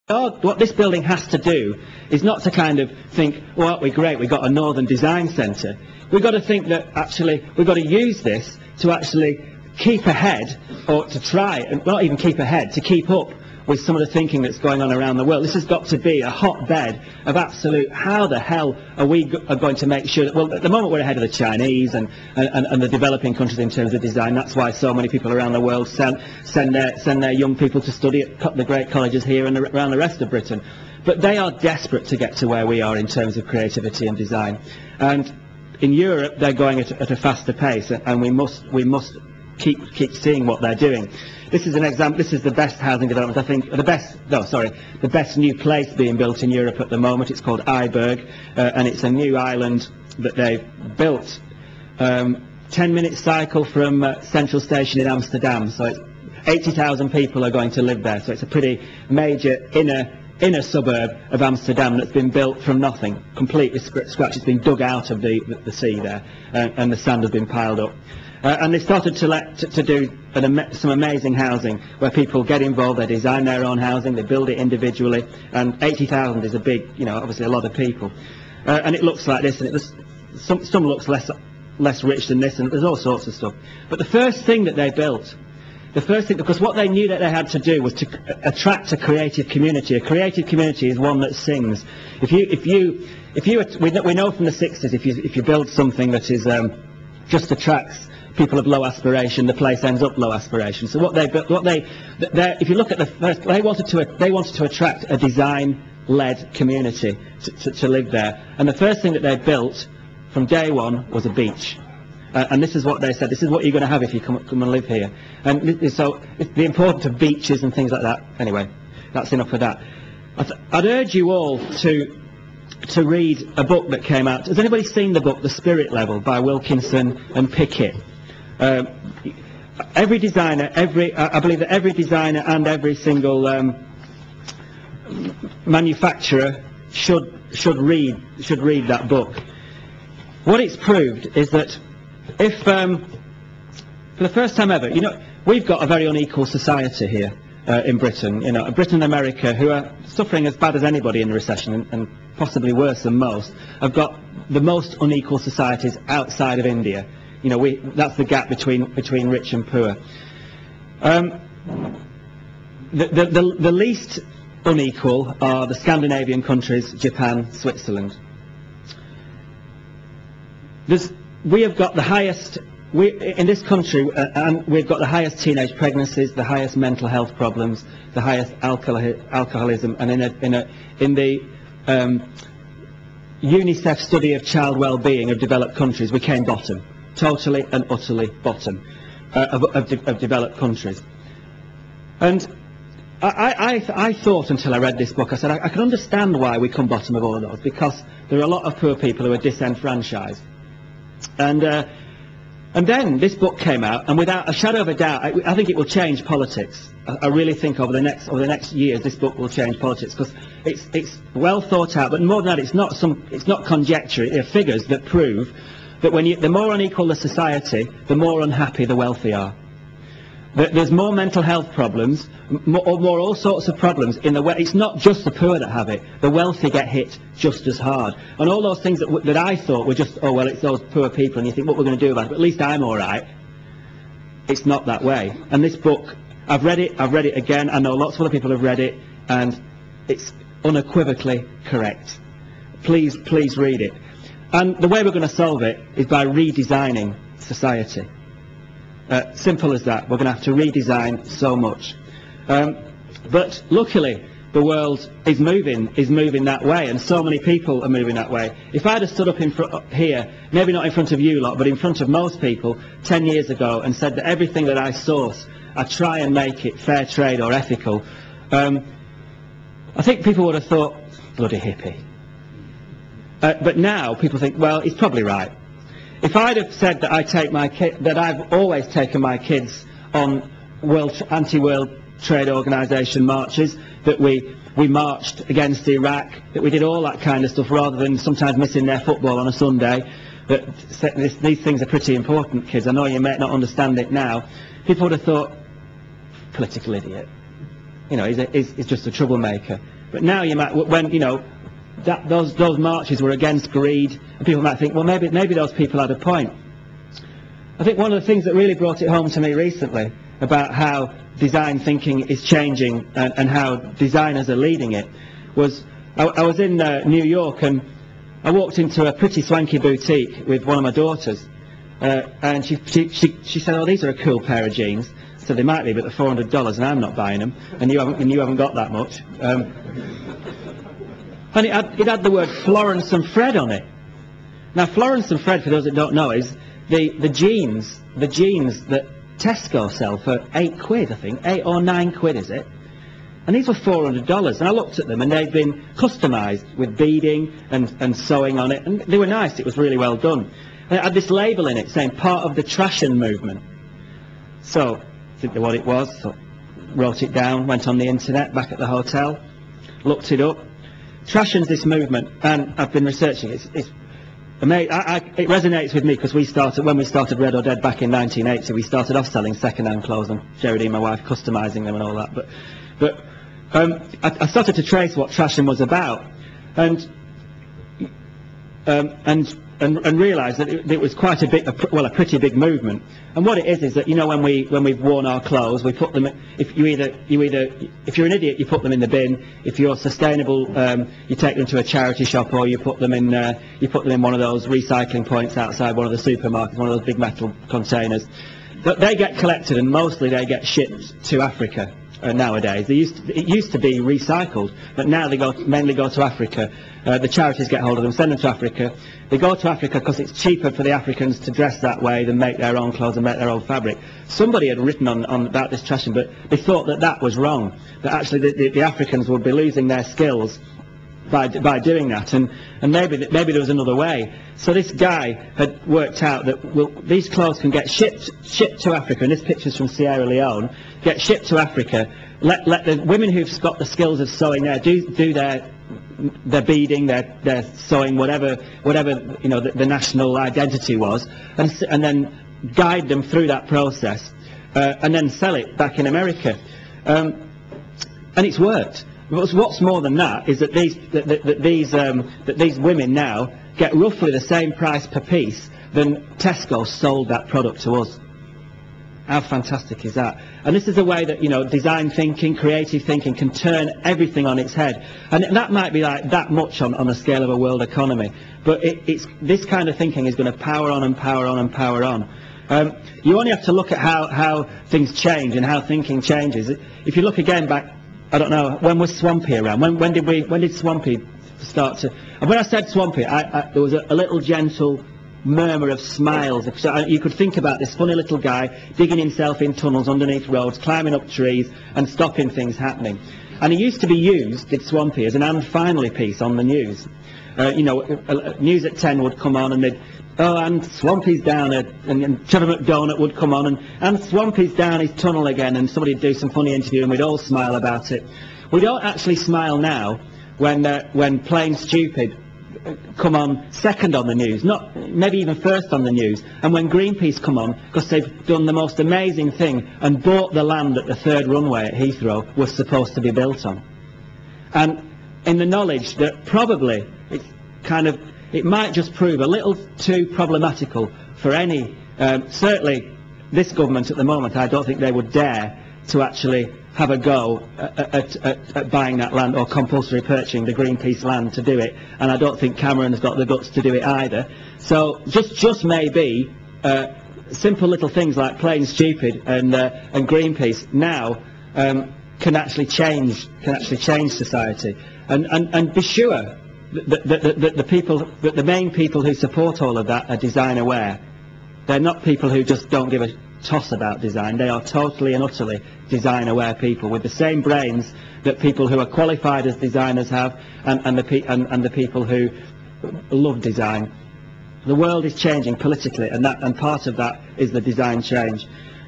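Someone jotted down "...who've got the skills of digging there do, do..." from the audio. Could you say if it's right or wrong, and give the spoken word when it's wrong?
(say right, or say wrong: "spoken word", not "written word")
wrong: "sewing", not "digging".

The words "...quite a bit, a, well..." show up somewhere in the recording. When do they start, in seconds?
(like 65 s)
381 s.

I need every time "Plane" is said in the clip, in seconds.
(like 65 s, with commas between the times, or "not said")
511 s, 548 s.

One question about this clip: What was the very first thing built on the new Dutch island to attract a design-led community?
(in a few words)
A beach.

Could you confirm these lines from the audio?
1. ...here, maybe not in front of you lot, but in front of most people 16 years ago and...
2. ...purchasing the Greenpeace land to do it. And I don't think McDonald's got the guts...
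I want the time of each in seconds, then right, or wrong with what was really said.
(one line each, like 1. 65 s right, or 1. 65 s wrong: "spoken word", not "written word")
1. 259 s wrong: "10", not "16"
2. 540 s wrong: "Cameron", not "McDonald".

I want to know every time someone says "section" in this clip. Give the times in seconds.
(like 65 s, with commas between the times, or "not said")
not said.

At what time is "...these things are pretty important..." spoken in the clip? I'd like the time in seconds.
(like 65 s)
291 s.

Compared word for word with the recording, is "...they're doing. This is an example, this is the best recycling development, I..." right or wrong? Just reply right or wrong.
wrong.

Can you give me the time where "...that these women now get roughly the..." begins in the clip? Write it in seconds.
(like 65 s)
452 s.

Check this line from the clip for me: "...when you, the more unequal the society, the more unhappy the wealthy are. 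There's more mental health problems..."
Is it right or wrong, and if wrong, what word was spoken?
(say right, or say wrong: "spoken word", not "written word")
right.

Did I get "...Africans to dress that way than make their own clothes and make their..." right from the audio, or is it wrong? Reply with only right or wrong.
right.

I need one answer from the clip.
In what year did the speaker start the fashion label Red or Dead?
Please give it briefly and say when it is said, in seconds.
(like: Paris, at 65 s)
1980, at 368 s.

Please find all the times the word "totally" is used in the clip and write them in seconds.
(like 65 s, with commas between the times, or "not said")
187 s, 564 s.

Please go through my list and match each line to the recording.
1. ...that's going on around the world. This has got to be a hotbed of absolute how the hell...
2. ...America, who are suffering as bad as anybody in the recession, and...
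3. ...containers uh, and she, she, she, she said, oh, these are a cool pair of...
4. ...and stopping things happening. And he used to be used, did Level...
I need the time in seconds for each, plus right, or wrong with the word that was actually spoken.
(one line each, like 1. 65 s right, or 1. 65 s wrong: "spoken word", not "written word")
1. 14 s right
2. 149 s right
3. 320 s wrong: "daughters", not "containers"
4. 491 s wrong: "Swampy", not "Level".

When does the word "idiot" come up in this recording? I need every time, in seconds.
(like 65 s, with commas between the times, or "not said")
296 s, 388 s.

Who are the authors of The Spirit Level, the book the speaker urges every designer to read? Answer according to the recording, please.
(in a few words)
Wilkinson and Pickett.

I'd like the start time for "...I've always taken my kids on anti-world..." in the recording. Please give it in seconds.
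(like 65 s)
278 s.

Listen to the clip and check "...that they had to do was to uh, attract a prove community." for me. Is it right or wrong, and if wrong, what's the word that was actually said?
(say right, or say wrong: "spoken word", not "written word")
wrong: "creative", not "prove".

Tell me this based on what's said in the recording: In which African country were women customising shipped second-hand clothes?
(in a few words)
Sierra Leone.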